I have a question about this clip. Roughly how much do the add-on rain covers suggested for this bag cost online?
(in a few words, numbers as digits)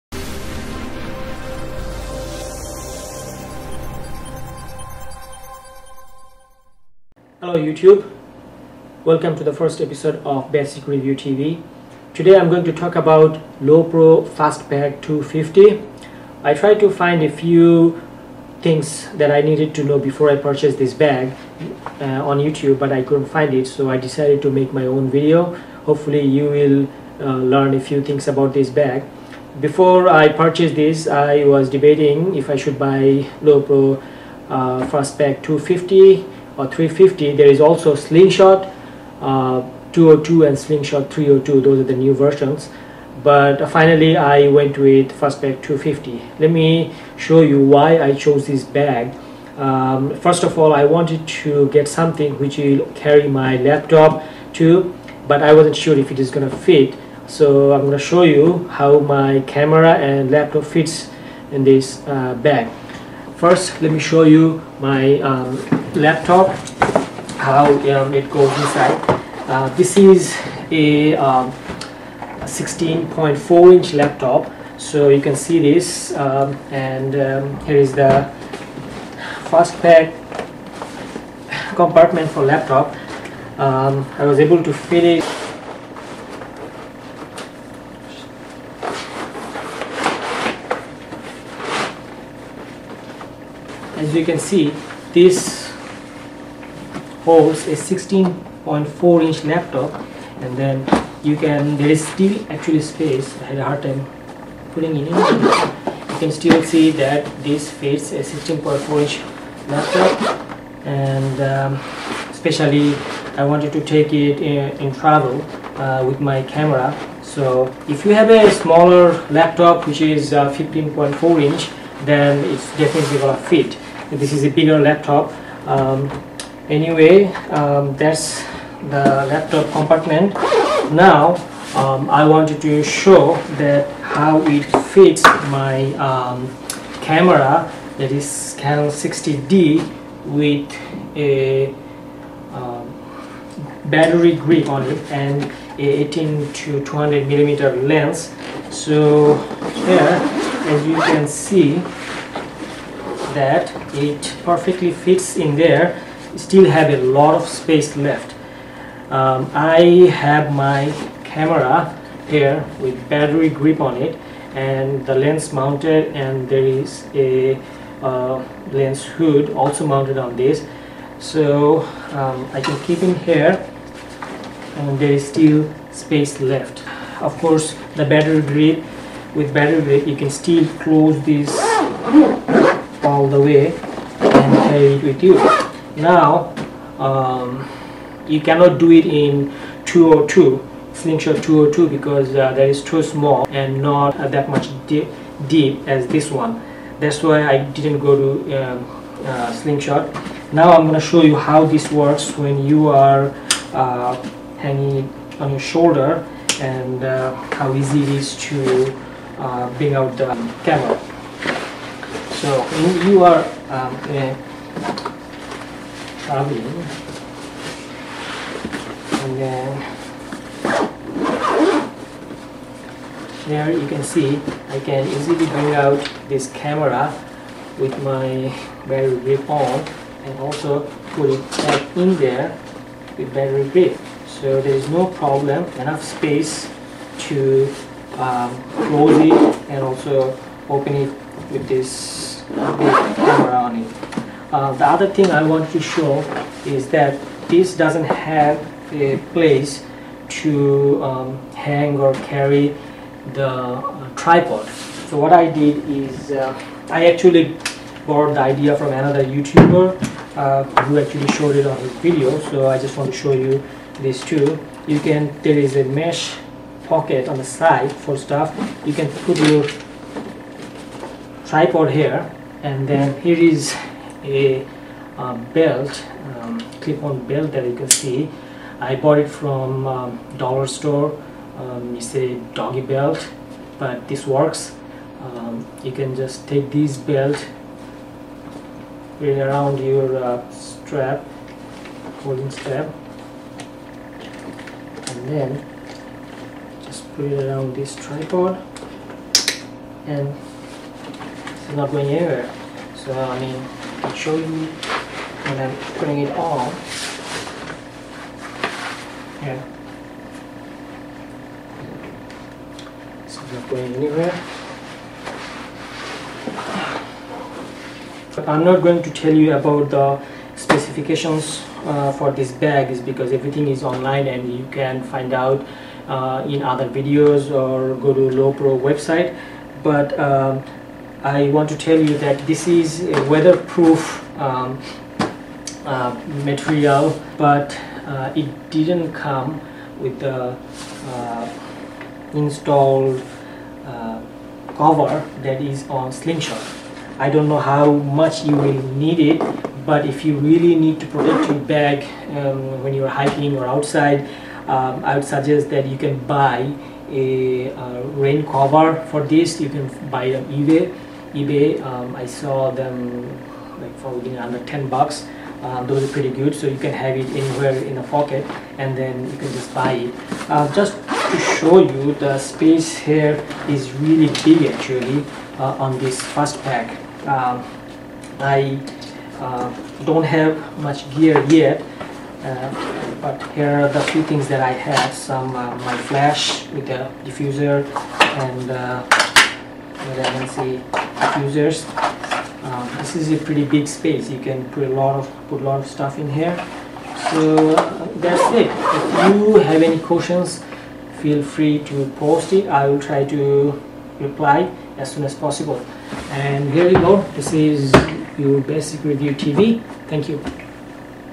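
under $10.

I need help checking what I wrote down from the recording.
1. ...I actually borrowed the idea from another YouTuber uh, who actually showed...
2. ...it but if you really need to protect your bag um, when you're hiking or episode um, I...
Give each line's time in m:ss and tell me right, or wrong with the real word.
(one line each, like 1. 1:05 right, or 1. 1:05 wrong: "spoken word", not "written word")
1. 4:16 right
2. 5:49 wrong: "outside", not "episode".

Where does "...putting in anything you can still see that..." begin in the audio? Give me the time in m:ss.
1:44.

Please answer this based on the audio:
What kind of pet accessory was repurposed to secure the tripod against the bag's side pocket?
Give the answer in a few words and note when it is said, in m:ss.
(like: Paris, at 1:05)
doggy belt, at 4:42.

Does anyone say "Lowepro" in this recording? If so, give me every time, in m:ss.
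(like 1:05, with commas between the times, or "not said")
0:13, 0:33, 5:28.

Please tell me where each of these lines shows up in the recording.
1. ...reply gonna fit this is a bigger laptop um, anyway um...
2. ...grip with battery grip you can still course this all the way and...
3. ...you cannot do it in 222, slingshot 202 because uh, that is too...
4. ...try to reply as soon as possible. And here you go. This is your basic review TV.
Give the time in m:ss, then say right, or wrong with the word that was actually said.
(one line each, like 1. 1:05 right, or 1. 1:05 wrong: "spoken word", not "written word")
1. 2:02 wrong: "definitely", not "reply"
2. 2:58 wrong: "close", not "course"
3. 3:08 wrong: "202", not "222"
4. 6:42 right.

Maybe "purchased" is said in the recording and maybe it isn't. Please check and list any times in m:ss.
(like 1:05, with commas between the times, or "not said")
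0:20, 0:30.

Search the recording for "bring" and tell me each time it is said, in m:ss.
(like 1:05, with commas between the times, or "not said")
3:29, 3:45.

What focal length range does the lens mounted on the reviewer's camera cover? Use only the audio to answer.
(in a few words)
18 to 200 millimeter.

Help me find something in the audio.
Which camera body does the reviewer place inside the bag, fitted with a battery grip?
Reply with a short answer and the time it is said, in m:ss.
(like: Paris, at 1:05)
Canon 60D, at 2:18.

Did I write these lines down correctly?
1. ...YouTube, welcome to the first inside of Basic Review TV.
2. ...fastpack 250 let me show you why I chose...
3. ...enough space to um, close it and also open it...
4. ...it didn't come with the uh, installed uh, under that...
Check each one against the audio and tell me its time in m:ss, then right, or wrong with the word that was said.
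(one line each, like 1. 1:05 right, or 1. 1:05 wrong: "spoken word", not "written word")
1. 0:07 wrong: "episode", not "inside"
2. 0:45 right
3. 3:55 right
4. 5:38 wrong: "cover", not "under".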